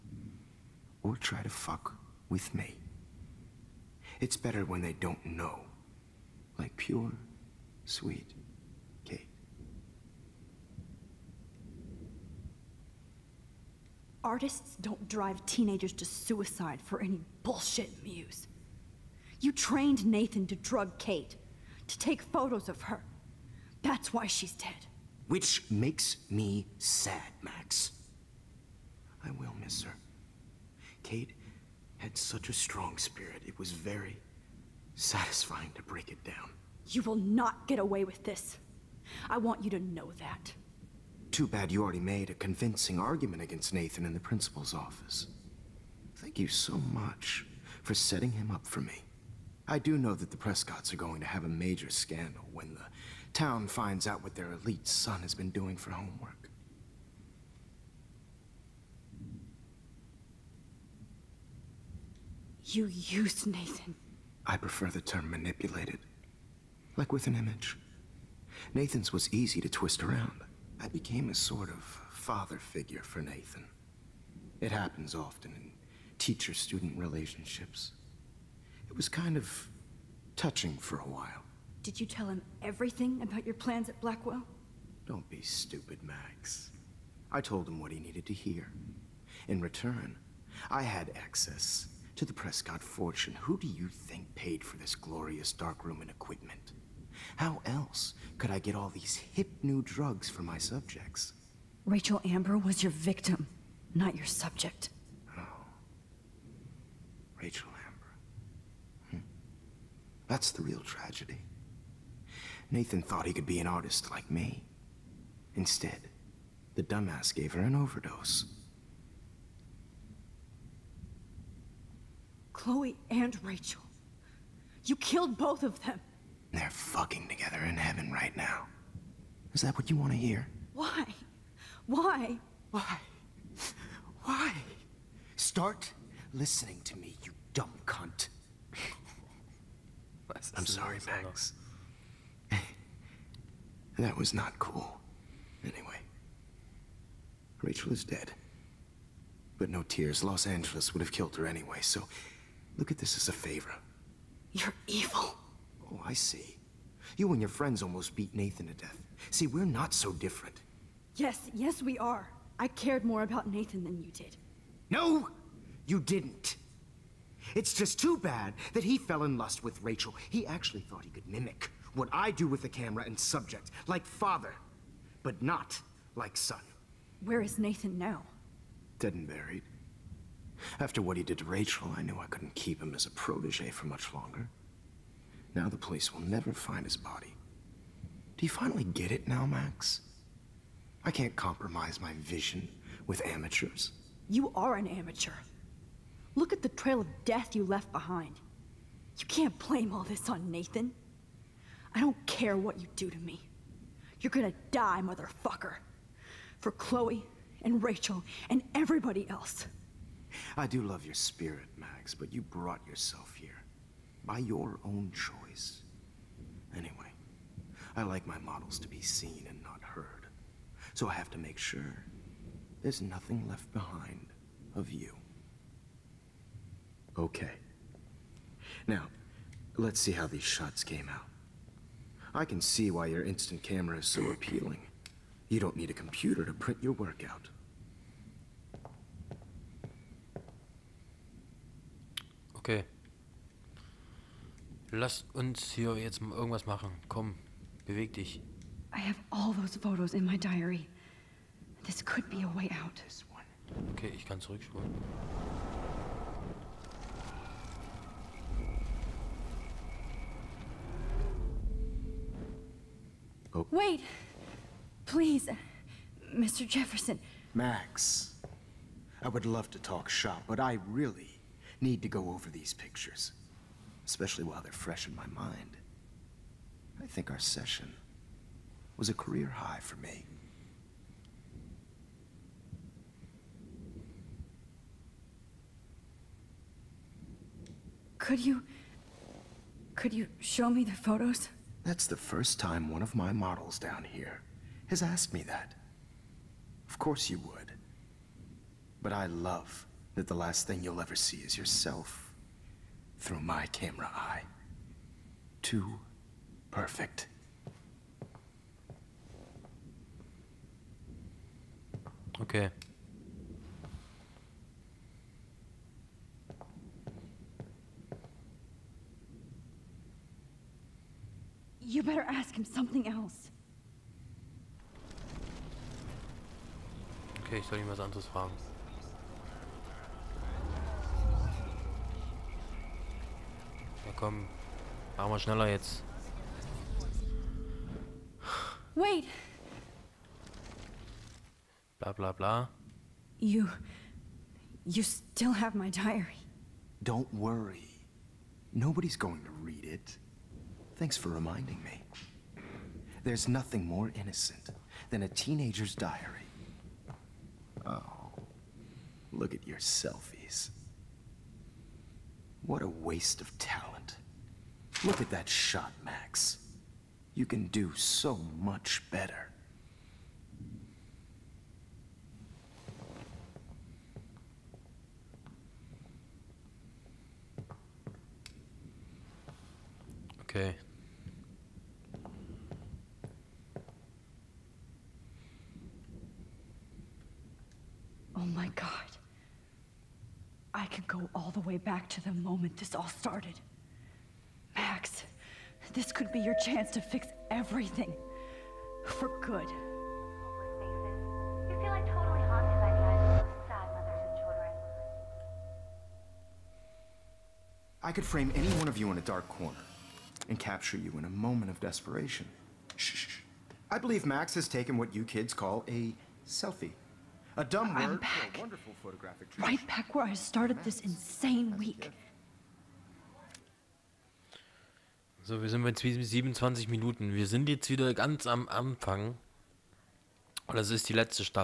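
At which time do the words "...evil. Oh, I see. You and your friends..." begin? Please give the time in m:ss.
2:34.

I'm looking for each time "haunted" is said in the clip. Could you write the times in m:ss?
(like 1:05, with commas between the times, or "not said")
not said.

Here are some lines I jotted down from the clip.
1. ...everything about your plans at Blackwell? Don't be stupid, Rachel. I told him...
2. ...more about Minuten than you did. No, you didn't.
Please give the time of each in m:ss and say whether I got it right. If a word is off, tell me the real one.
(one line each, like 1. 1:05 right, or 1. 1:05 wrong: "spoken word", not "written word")
1. 1:22 wrong: "Max", not "Rachel"
2. 2:43 wrong: "Nathan", not "Minuten".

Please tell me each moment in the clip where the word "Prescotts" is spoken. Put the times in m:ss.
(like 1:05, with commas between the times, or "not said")
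0:50, 1:32.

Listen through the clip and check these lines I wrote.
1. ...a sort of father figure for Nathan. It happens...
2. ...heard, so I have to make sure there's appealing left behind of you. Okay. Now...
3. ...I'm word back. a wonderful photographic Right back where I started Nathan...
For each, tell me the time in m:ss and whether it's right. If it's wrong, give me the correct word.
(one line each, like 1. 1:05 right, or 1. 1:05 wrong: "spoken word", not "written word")
1. 1:11 right
2. 3:39 wrong: "nothing", not "appealing"
3. 6:57 wrong: "Max", not "Nathan".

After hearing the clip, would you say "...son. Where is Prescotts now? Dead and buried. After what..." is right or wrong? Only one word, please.
wrong.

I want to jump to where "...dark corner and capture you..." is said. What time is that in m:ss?
6:49.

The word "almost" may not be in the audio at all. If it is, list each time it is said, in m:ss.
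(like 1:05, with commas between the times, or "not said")
2:37.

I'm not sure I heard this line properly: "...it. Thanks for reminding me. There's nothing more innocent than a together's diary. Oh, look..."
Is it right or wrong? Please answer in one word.
wrong.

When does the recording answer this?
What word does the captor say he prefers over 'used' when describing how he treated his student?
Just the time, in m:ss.
1:05.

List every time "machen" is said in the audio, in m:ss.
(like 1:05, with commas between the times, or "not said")
4:06, 5:35.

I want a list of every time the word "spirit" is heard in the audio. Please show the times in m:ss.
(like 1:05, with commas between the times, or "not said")
0:32, 3:31.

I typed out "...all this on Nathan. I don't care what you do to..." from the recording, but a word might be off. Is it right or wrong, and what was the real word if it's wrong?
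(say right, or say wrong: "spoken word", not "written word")
right.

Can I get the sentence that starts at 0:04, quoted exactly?
It's better when they don't know.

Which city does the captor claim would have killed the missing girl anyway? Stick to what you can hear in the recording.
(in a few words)
Los Angeles.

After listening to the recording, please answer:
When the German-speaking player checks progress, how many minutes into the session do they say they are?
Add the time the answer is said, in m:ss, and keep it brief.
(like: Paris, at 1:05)
27, at 7:05.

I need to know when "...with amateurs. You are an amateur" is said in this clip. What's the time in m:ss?
3:13.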